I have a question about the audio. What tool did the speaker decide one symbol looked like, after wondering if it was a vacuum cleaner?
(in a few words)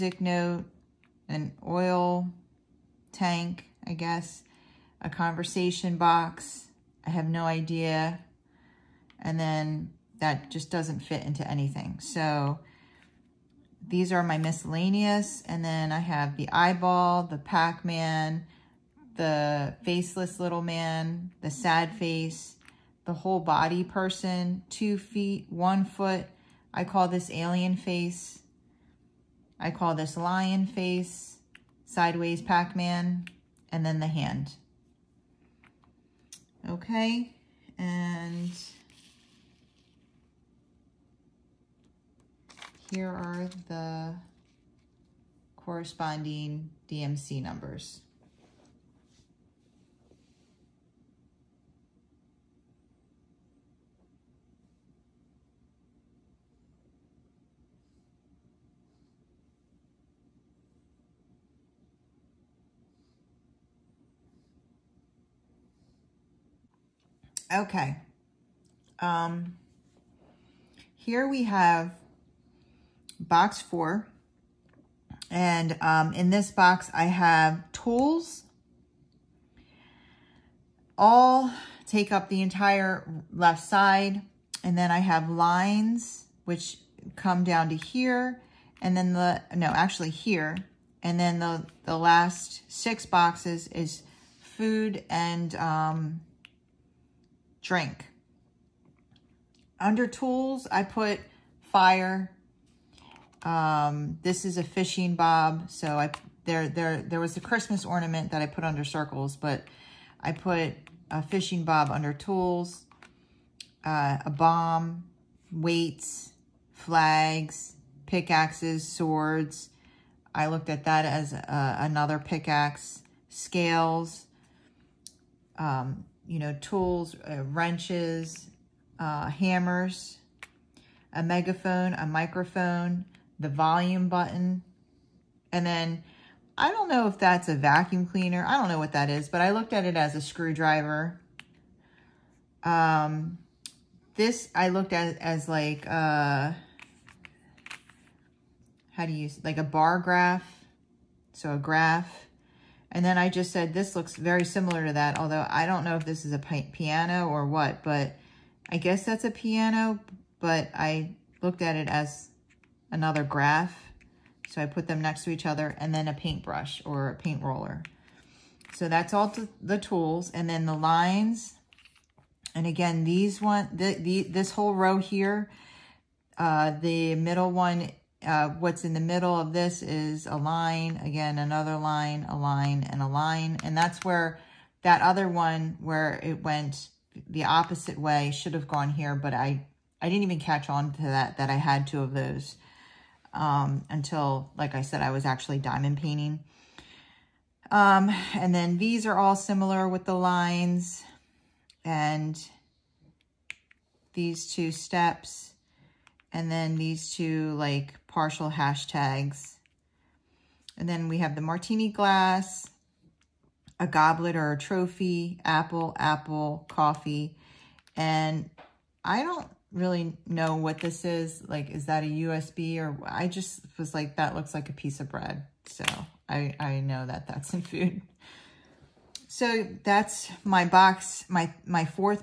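screwdriver.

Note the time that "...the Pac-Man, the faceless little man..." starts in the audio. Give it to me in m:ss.
0:17.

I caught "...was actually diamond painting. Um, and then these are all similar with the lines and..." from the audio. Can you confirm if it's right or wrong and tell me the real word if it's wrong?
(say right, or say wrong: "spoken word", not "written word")
right.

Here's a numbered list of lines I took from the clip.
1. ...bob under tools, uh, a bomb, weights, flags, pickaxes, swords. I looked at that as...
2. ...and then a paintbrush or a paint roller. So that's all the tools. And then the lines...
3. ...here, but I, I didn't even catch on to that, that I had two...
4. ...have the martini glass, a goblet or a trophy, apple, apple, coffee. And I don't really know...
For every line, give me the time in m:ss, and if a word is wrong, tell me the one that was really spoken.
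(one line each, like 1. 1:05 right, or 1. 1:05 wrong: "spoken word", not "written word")
1. 1:51 right
2. 2:45 right
3. 3:08 right
4. 3:31 right.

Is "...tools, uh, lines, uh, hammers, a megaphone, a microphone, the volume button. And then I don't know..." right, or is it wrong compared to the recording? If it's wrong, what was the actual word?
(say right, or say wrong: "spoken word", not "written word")
wrong: "wrenches", not "lines".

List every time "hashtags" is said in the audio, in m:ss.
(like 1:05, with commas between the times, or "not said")
3:28.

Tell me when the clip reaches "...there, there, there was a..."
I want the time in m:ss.
1:46.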